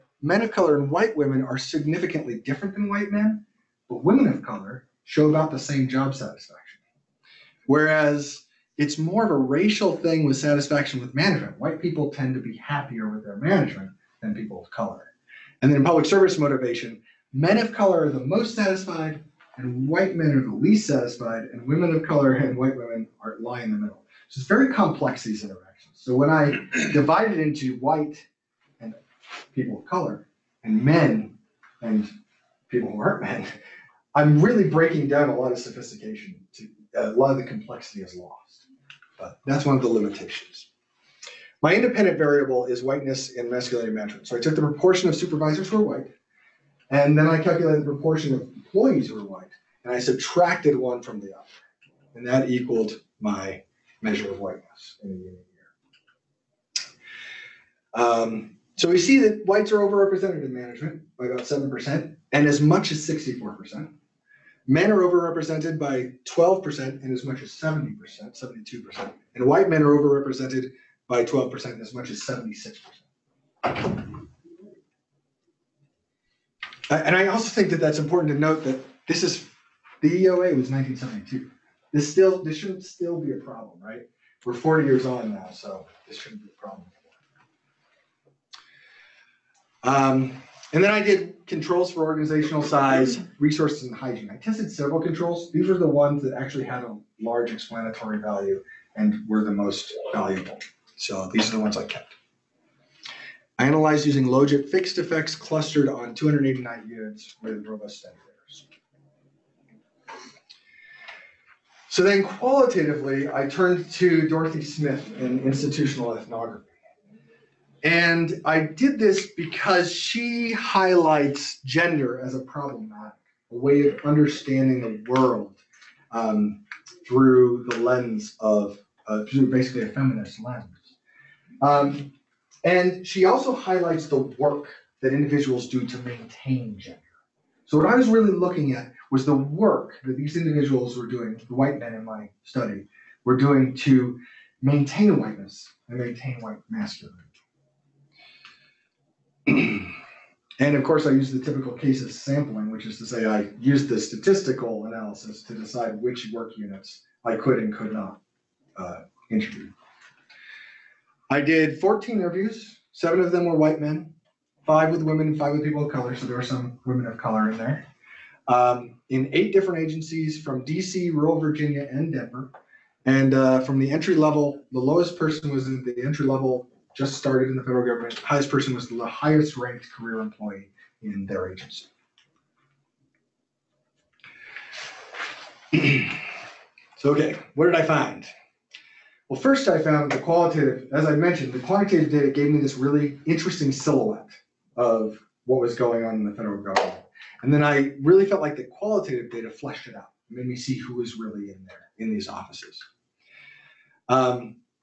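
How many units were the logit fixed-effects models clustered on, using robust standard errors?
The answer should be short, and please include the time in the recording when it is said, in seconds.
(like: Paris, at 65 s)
289, at 106 s.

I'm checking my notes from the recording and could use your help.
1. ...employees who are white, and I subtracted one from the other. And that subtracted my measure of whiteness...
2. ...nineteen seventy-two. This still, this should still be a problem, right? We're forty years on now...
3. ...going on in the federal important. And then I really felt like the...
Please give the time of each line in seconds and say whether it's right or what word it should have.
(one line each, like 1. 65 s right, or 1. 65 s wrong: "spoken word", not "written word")
1. 48 s wrong: "equaled", not "subtracted"
2. 80 s right
3. 195 s wrong: "government", not "important".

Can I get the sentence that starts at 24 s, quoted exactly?
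So it's very complex these interactions.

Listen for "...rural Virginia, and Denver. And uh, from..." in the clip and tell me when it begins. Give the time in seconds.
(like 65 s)
171 s.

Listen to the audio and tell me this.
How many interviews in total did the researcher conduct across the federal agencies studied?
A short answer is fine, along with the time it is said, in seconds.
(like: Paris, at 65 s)
14, at 161 s.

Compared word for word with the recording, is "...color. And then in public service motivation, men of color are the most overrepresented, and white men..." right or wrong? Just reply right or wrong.
wrong.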